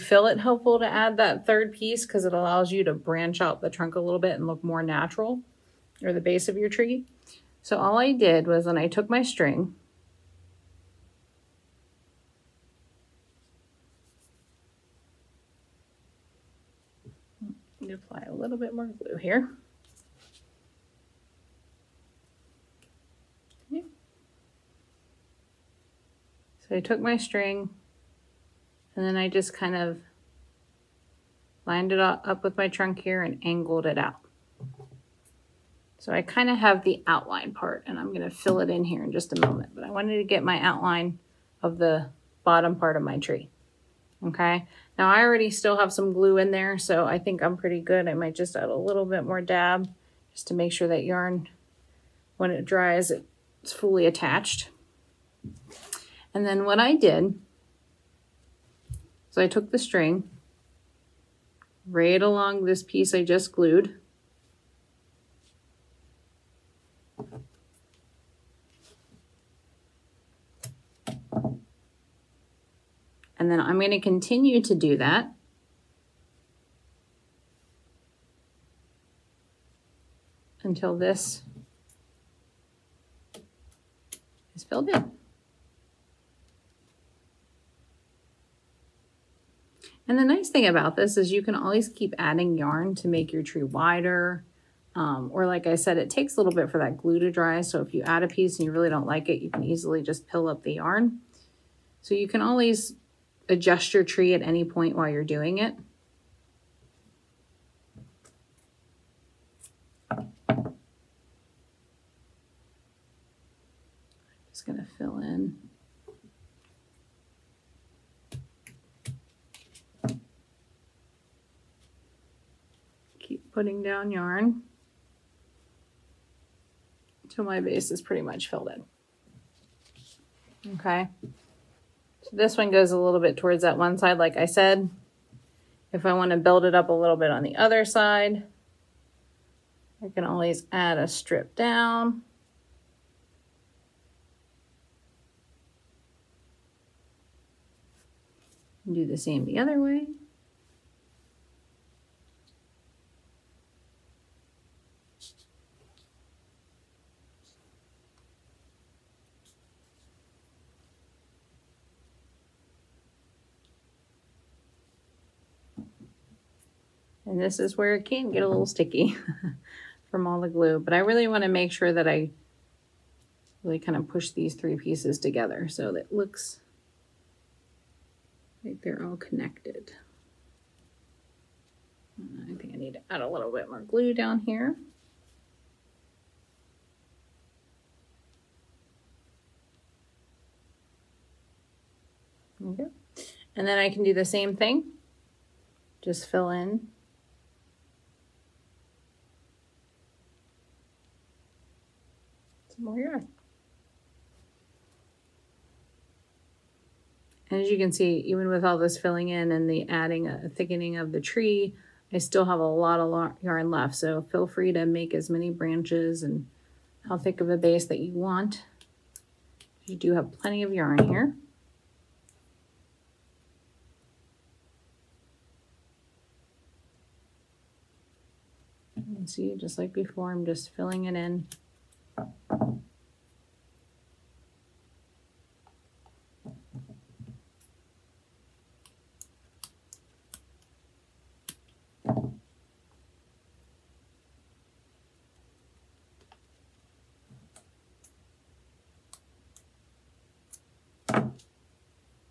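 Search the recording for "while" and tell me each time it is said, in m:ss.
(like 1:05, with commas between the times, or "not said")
1:44.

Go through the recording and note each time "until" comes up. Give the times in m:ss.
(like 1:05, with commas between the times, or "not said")
1:20, 2:07.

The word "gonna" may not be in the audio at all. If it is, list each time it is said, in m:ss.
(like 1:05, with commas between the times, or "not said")
1:54.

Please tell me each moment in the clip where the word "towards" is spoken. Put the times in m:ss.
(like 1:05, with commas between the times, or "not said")
2:13.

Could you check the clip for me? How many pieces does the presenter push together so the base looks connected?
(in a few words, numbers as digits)
3.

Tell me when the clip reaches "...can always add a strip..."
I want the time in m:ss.
2:20.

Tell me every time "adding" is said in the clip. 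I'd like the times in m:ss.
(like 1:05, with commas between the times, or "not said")
1:32, 3:29.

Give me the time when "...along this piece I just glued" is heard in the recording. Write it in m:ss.
1:02.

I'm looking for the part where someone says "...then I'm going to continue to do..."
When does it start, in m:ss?
1:13.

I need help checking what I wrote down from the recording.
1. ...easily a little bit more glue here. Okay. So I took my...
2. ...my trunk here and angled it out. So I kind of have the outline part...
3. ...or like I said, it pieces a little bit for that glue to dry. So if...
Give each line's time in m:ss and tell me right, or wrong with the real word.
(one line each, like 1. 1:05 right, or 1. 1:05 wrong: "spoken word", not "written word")
1. 0:17 wrong: "apply", not "easily"
2. 0:32 right
3. 1:35 wrong: "takes", not "pieces".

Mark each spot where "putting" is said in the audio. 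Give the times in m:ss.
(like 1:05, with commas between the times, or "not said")
2:03.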